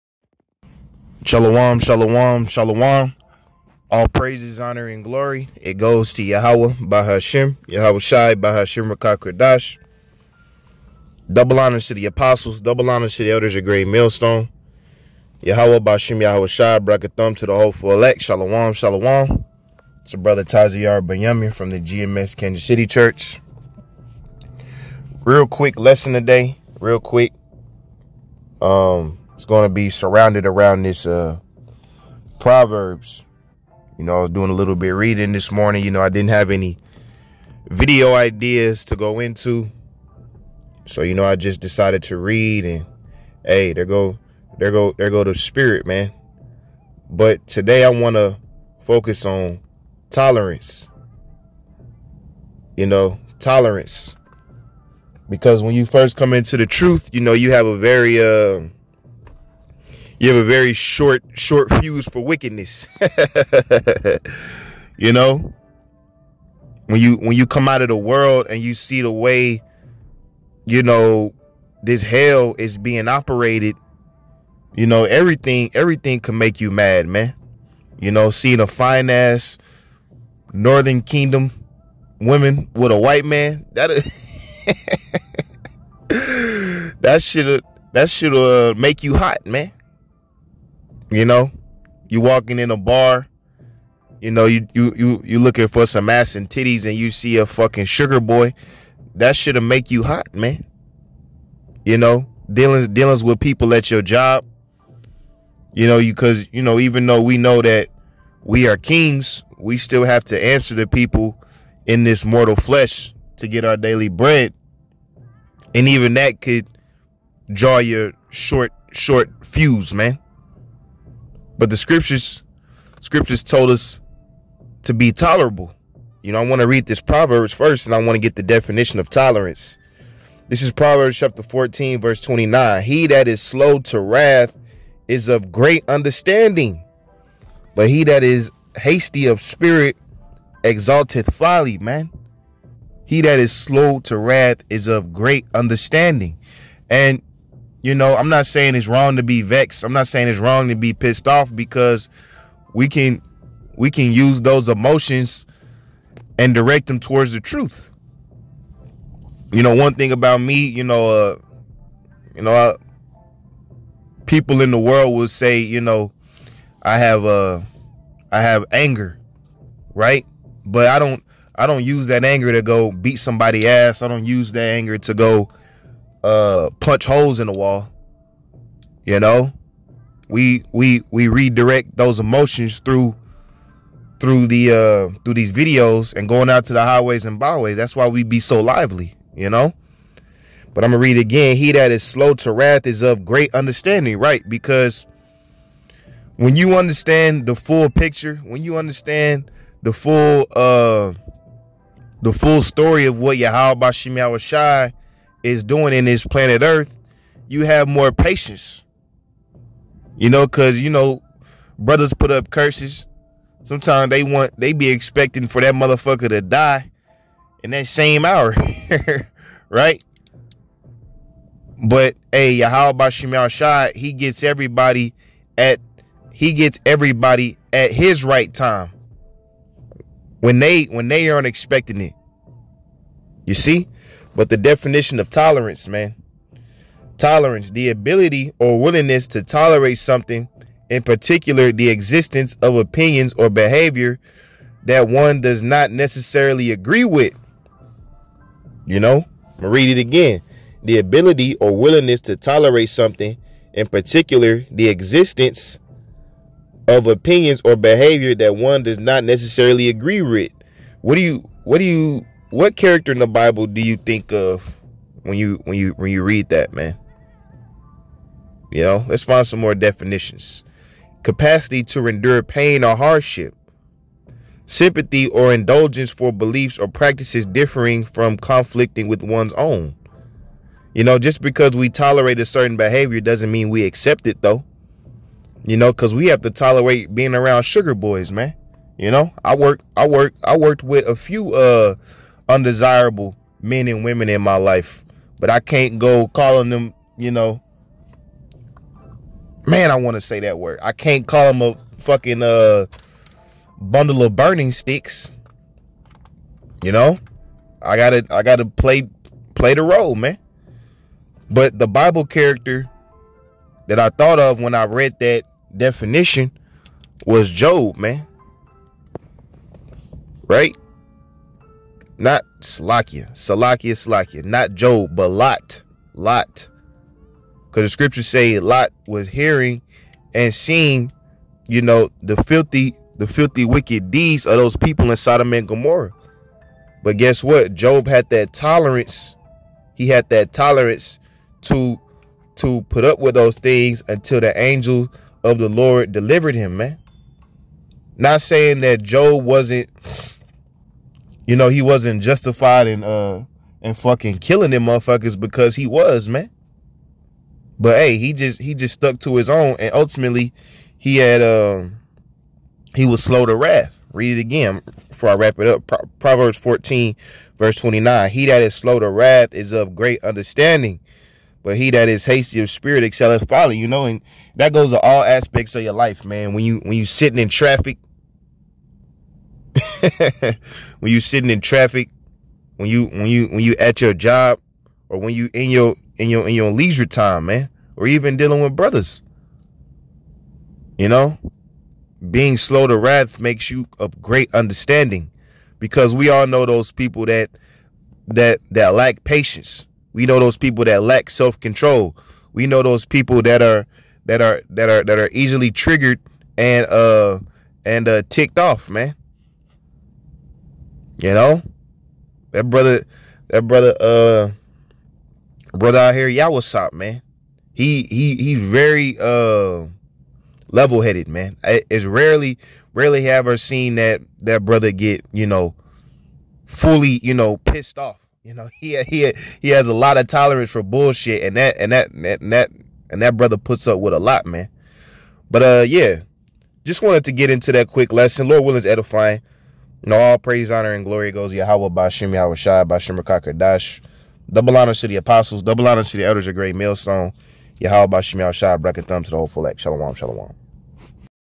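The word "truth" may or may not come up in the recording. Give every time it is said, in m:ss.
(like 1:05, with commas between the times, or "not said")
0:56, 2:37.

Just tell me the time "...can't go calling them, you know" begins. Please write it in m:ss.
4:55.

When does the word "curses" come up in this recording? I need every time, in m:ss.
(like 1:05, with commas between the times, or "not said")
3:32.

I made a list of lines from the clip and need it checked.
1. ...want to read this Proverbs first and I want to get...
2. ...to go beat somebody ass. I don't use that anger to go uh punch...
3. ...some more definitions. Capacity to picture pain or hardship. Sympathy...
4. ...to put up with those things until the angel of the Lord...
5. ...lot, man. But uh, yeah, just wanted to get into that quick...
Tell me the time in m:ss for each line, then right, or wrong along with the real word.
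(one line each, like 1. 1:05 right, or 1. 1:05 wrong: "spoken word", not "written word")
1. 2:06 right
2. 2:52 right
3. 4:29 wrong: "endure", not "picture"
4. 5:42 right
5. 7:14 right.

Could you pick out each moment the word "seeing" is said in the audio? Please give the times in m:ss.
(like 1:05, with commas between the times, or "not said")
1:18, 5:30.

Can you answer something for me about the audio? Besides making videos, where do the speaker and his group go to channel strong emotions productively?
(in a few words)
Highways and byways.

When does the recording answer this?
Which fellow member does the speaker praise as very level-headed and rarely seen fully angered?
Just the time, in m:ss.
6:56.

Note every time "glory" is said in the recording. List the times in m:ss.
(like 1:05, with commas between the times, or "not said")
0:05, 7:21.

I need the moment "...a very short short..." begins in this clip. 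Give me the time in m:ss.
1:00.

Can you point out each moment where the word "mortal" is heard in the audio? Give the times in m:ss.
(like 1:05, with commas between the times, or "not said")
1:52.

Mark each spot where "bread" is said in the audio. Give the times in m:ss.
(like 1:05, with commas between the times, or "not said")
1:54.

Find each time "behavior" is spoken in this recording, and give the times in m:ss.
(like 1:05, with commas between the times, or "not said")
4:03, 4:17, 4:42.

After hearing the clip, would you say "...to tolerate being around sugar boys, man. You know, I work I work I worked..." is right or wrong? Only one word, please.
right.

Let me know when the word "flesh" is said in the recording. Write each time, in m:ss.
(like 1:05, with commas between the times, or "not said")
1:52.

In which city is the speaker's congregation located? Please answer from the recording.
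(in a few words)
Kansas City.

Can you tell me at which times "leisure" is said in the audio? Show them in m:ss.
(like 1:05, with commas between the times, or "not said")
6:26.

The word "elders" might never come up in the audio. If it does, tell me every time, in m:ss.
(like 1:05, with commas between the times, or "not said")
0:13, 7:26.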